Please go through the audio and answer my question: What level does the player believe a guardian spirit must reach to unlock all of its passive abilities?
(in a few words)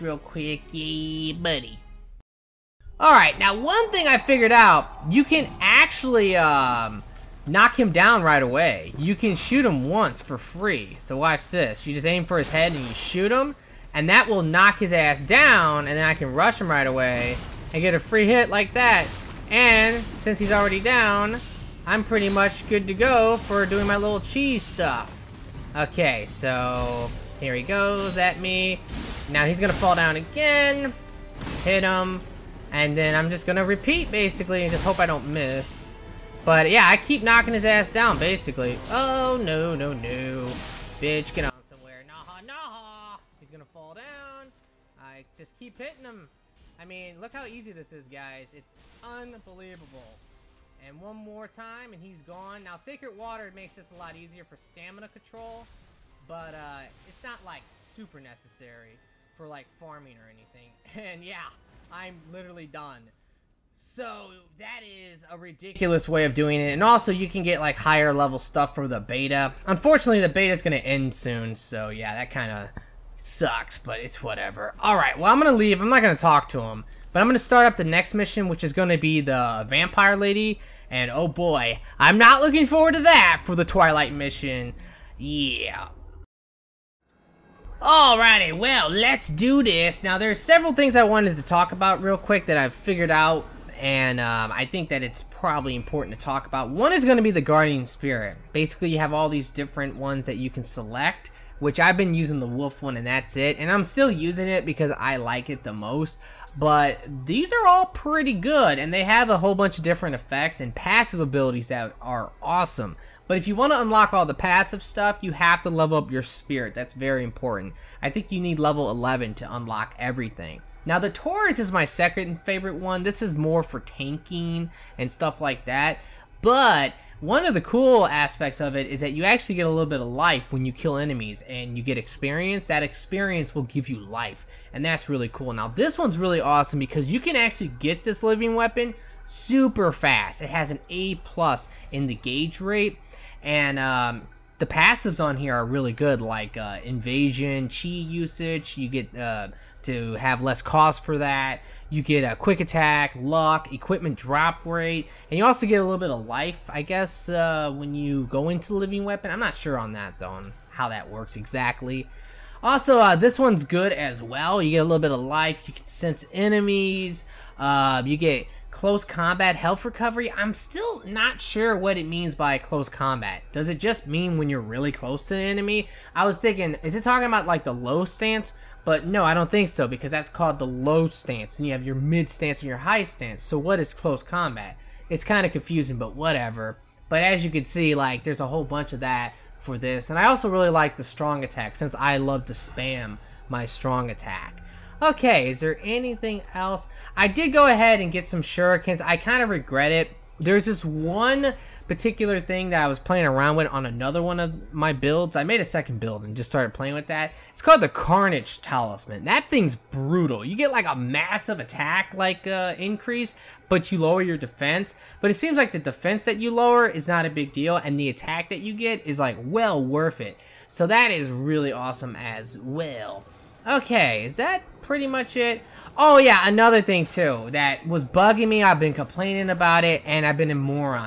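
11.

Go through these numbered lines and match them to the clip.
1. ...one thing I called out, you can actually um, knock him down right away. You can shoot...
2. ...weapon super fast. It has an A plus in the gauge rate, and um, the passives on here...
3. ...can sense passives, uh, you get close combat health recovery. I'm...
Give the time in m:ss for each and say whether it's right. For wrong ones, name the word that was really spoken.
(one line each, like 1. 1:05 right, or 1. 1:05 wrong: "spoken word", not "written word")
1. 0:03 wrong: "figured", not "called"
2. 2:18 right
3. 2:45 wrong: "enemies", not "passives".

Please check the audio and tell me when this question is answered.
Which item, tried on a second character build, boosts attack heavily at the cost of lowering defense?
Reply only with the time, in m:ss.
3:27.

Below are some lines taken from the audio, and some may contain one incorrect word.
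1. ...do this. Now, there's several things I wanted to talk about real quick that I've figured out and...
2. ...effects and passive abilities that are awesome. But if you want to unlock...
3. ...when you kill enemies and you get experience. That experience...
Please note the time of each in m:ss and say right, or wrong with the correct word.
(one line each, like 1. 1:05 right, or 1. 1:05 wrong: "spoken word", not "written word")
1. 1:29 right
2. 1:50 right
3. 2:10 right.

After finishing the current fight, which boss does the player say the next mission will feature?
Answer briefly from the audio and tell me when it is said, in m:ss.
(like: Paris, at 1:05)
the vampire lady, at 1:19.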